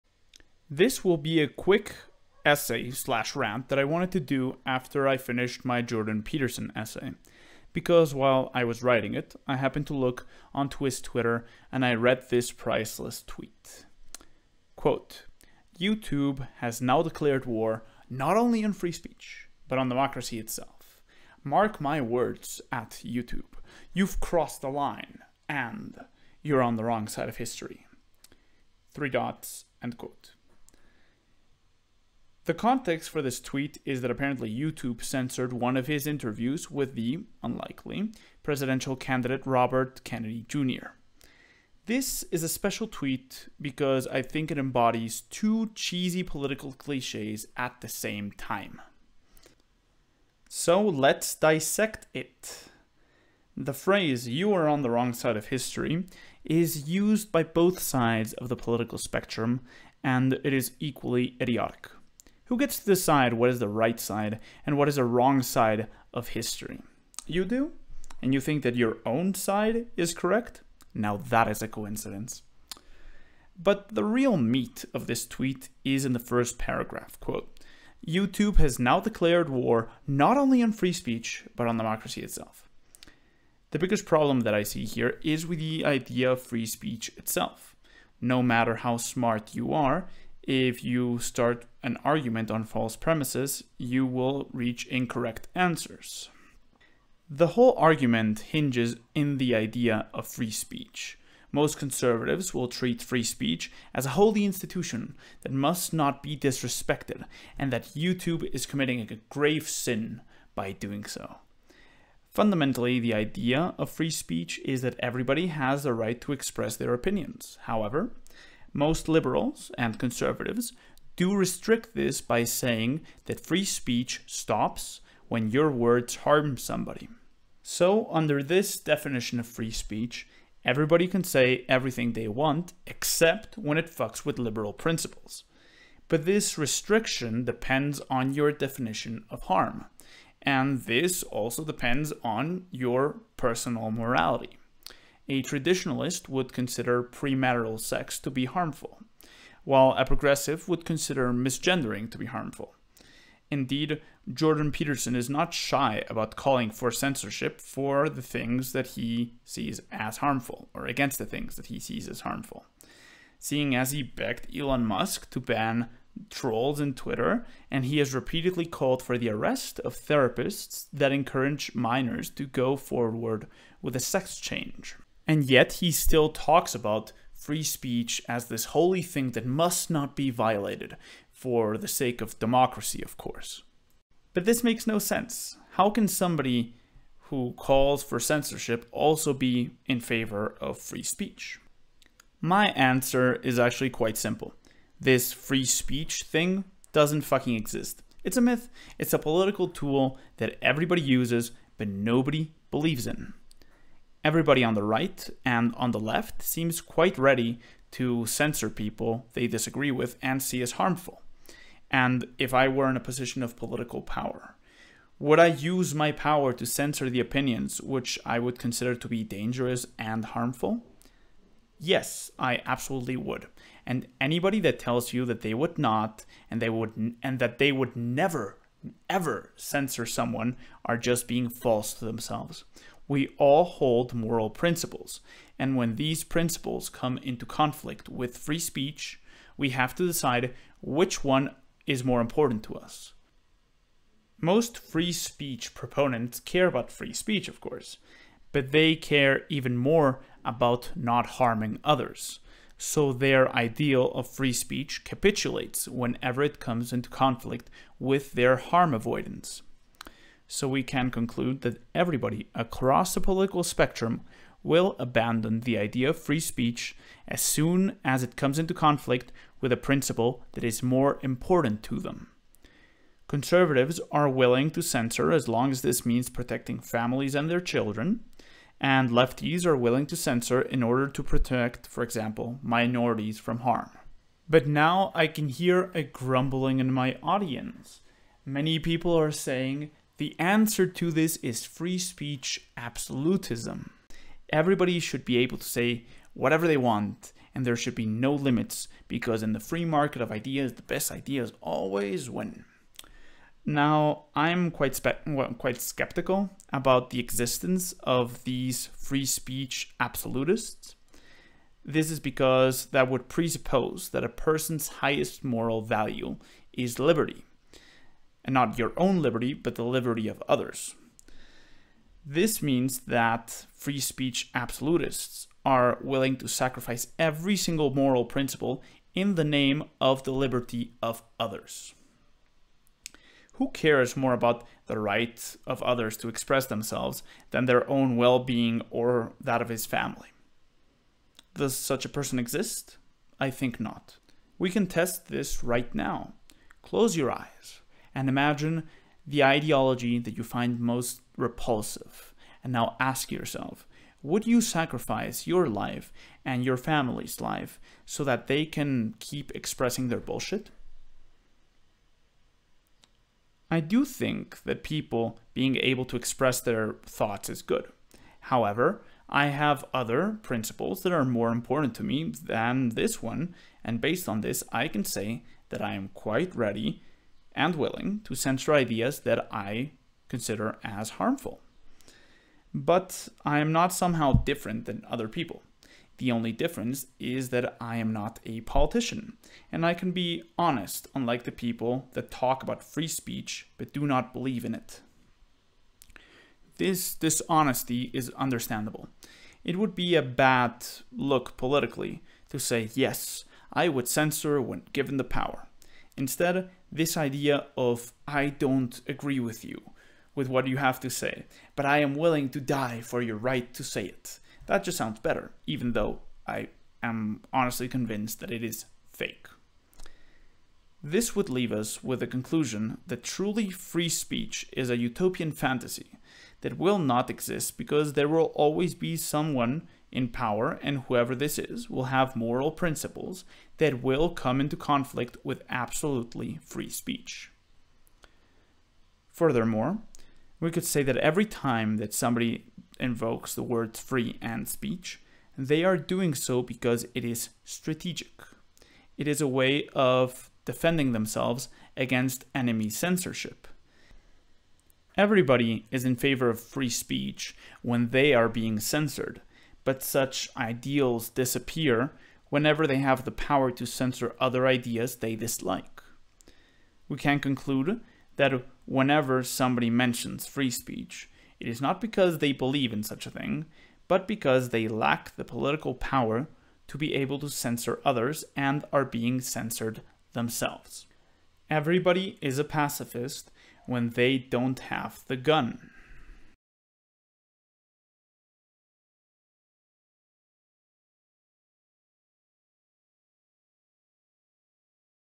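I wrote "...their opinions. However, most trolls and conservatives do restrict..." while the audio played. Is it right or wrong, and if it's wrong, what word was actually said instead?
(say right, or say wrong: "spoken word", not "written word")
wrong: "liberals", not "trolls".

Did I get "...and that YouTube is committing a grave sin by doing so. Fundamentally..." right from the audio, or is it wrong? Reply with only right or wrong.
right.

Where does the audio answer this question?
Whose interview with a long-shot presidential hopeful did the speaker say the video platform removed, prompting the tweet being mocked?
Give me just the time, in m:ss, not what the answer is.
0:39.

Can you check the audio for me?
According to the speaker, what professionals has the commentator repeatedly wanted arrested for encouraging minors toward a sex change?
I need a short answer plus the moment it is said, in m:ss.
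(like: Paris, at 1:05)
Therapists, at 2:49.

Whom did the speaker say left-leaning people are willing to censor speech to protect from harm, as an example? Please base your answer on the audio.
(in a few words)
Minorities.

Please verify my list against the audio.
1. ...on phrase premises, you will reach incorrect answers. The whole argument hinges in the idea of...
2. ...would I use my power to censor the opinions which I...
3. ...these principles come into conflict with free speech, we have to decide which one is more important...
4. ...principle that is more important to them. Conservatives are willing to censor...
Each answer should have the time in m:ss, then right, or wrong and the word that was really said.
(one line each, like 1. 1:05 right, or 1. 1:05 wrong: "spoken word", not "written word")
1. 1:32 wrong: "false", not "phrase"
2. 3:35 right
3. 3:55 right
4. 4:29 right.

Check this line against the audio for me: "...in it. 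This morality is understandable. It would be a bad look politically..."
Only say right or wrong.
wrong.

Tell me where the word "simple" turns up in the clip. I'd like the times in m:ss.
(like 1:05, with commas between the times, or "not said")
3:14.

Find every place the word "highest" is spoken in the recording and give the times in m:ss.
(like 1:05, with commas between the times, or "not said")
5:14.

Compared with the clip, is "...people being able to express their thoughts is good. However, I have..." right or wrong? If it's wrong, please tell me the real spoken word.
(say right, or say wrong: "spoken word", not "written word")
right.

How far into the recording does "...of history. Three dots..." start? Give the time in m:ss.
0:27.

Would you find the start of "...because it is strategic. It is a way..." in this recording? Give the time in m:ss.
7:26.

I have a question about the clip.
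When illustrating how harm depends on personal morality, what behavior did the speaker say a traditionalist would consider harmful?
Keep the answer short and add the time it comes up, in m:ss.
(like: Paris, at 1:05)
Premarital sex, at 2:27.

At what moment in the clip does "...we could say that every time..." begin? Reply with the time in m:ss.
7:20.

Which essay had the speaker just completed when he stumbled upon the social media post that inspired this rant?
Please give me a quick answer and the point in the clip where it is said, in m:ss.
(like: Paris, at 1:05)
Jordan Peterson essay, at 0:05.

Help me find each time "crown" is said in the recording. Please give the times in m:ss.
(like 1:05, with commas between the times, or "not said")
not said.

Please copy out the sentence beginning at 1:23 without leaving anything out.
The biggest problem that I see here is with the idea of free speech itself.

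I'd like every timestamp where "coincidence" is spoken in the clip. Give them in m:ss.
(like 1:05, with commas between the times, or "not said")
1:11.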